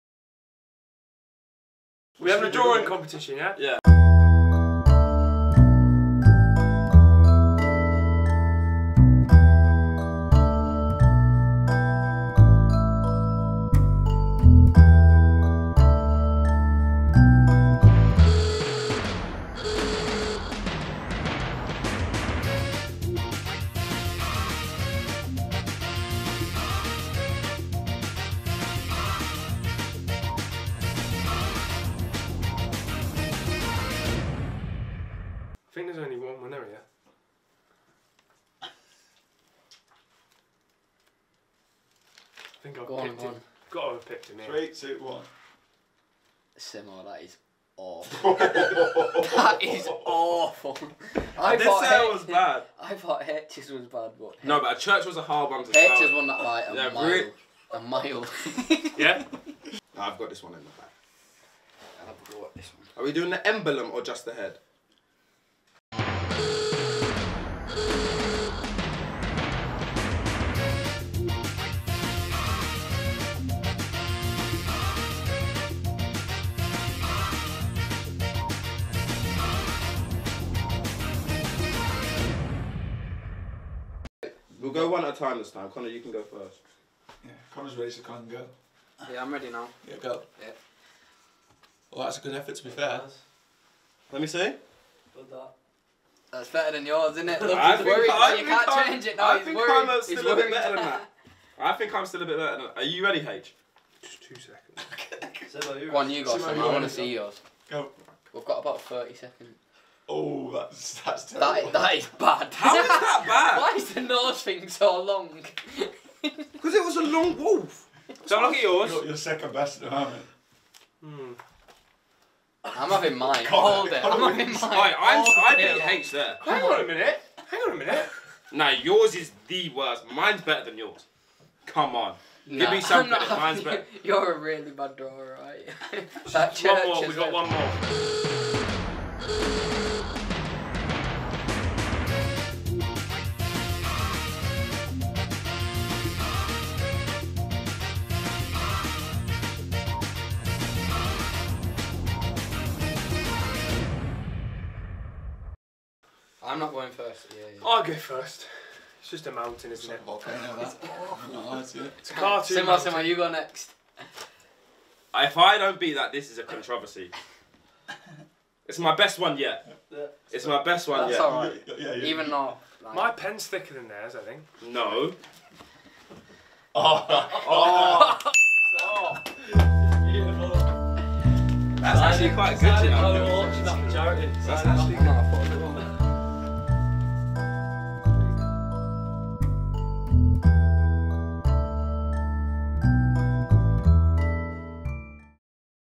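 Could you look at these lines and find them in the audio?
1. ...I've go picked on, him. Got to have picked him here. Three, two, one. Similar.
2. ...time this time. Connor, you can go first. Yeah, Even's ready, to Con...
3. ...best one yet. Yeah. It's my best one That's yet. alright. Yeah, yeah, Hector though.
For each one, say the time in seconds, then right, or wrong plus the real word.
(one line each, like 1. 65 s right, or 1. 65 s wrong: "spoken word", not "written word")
1. 42 s right
2. 85 s wrong: "Connor", not "Even"
3. 168 s wrong: "Even", not "Hector".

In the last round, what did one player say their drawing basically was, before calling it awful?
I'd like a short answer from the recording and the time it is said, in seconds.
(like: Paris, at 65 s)
A mountain, at 159 s.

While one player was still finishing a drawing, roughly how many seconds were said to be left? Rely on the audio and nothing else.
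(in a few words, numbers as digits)
30 seconds.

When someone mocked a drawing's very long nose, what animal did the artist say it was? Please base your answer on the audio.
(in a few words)
A long wolf.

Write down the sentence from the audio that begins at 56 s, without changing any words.
one that like a yeah, mile, really?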